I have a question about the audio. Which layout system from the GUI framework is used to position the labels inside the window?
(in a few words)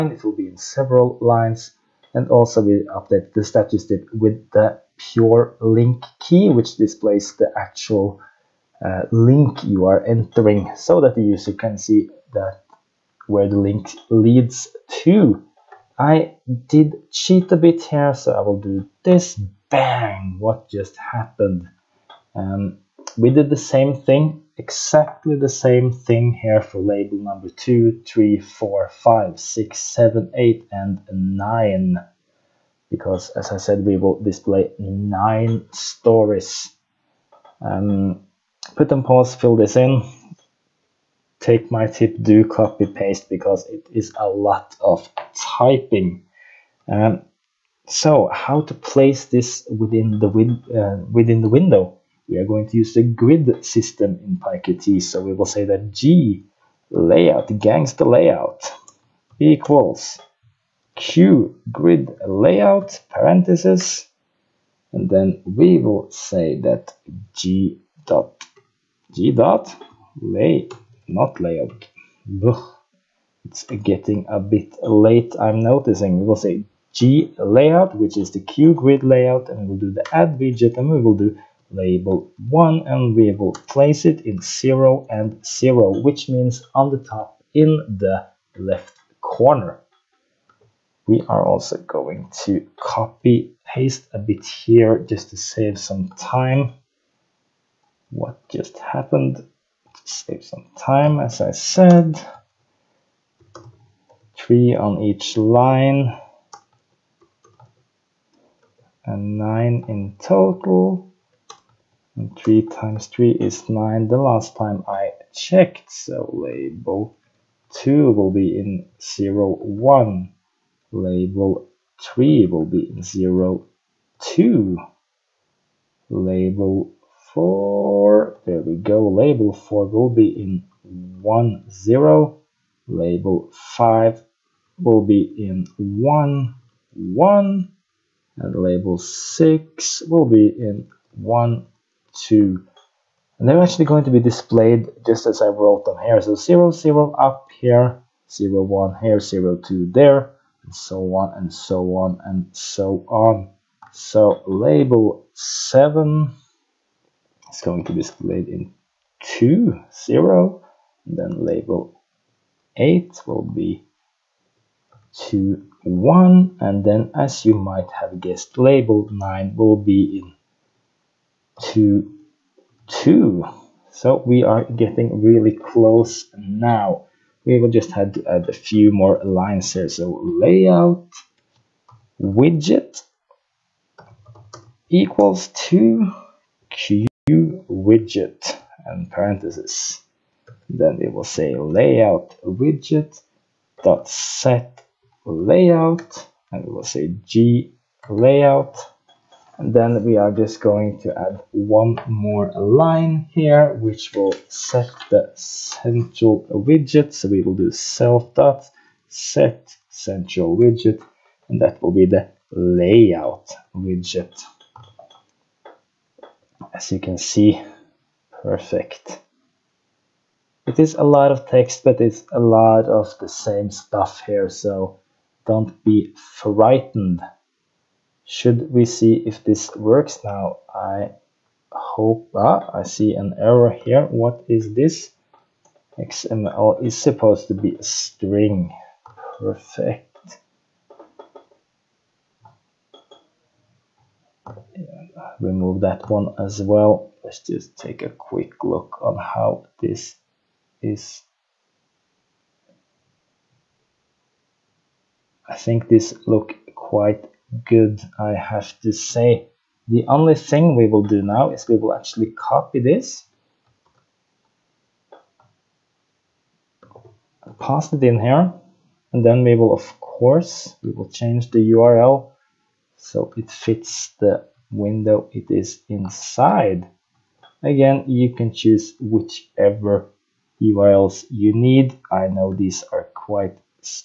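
grid system.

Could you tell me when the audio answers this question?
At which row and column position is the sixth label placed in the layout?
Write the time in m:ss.
2:18.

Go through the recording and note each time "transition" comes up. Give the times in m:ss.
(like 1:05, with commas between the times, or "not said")
not said.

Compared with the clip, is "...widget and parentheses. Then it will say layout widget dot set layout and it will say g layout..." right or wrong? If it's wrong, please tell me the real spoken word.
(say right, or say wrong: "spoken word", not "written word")
right.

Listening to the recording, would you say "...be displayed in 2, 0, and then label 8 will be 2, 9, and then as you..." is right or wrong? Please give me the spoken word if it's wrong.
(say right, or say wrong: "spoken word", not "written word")
wrong: "1", not "9".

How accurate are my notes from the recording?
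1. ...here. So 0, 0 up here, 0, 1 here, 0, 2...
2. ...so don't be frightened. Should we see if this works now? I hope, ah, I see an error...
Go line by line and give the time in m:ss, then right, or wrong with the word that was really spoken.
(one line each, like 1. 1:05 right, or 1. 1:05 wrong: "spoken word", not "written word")
1. 2:26 right
2. 3:44 right.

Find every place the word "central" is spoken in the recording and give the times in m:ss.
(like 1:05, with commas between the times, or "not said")
3:25, 3:29.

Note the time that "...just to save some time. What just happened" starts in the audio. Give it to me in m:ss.
1:34.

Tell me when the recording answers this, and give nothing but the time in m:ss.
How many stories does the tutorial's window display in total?
0:34.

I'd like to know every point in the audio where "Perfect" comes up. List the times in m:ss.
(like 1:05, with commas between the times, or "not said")
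3:38, 3:59.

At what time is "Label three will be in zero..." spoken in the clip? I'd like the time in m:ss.
2:00.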